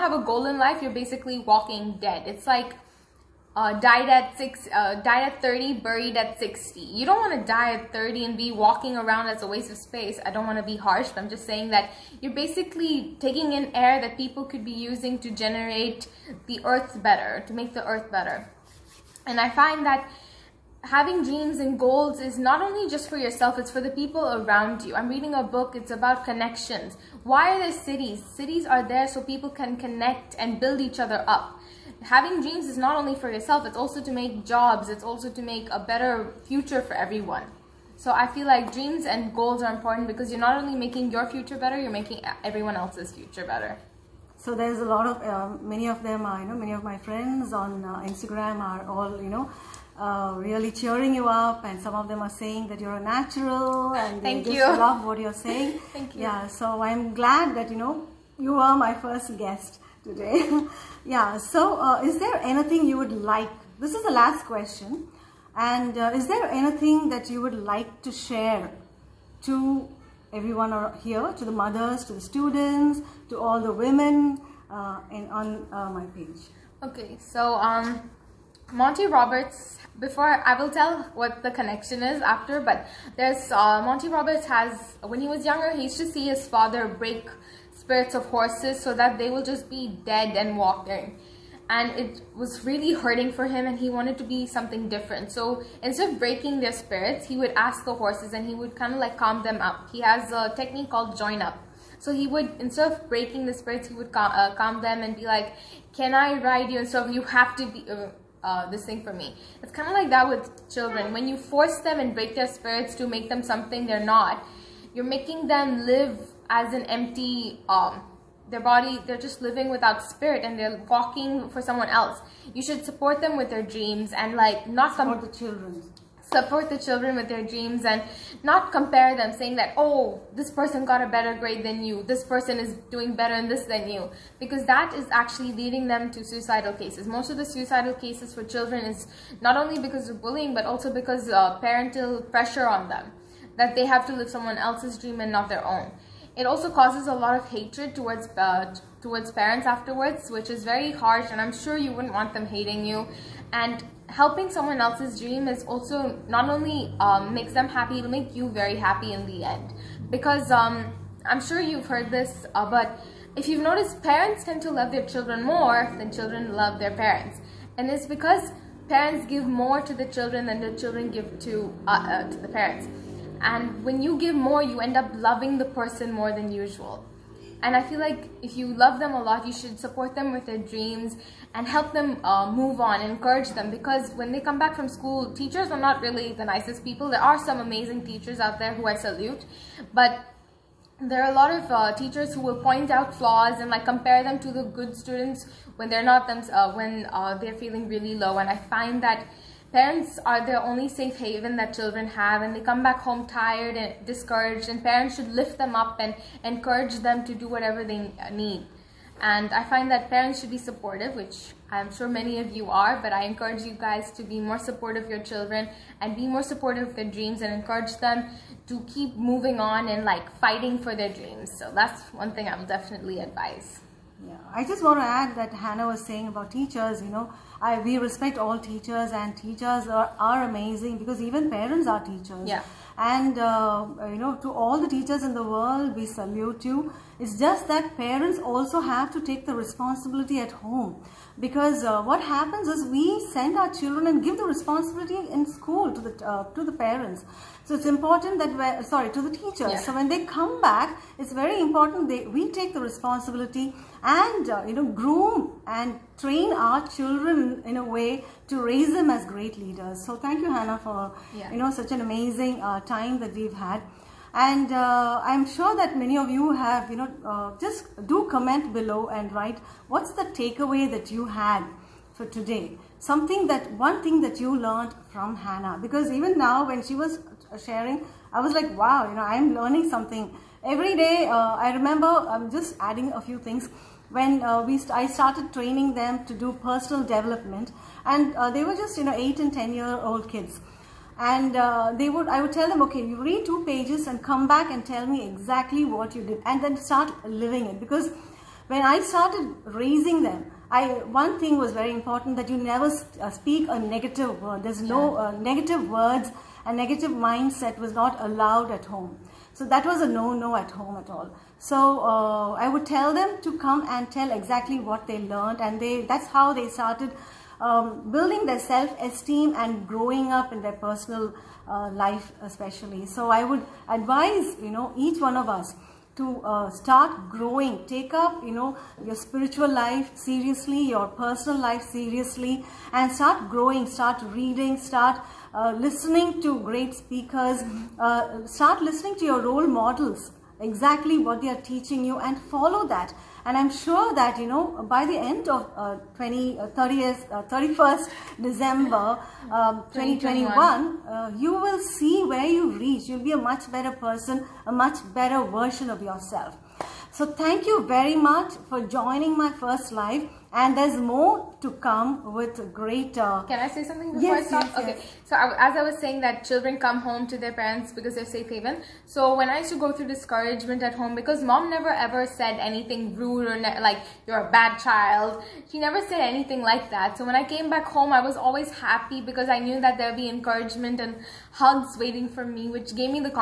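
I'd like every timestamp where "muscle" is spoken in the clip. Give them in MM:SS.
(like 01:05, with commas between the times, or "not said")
not said.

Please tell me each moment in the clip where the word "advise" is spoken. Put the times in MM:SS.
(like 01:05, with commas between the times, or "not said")
03:43, 05:23.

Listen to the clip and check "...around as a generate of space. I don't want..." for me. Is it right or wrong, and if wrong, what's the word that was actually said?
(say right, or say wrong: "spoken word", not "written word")
wrong: "waste", not "generate".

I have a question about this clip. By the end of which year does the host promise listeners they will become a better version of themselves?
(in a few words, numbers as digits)
2021.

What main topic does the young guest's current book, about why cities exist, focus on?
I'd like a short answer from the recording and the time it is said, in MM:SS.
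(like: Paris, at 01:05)
Connections, at 00:26.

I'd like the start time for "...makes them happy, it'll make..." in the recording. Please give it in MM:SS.
02:37.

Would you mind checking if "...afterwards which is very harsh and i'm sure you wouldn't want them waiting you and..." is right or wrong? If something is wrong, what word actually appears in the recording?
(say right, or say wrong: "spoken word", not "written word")
wrong: "hating", not "waiting".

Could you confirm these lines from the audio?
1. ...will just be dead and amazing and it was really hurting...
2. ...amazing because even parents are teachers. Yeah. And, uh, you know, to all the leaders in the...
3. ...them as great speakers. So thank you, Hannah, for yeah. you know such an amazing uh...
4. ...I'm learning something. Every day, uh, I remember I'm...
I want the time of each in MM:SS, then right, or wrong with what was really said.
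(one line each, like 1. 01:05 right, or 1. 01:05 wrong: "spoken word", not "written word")
1. 01:29 wrong: "walking", not "amazing"
2. 03:50 wrong: "teachers", not "leaders"
3. 04:18 wrong: "leaders", not "speakers"
4. 04:39 right.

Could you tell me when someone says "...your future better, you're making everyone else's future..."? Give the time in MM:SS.
00:41.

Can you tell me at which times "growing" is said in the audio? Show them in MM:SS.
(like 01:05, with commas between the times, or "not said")
05:19, 05:27, 05:33.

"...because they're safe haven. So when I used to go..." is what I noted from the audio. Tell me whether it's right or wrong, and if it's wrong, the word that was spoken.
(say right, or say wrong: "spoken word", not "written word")
right.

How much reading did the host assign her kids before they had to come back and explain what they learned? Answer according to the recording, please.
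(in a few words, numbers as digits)
2 pages.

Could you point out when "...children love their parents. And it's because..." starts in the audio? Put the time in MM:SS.
02:46.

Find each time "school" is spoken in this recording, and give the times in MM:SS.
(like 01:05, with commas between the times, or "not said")
03:04, 04:05.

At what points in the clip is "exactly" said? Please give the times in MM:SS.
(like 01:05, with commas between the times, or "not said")
04:55, 05:14, 05:40.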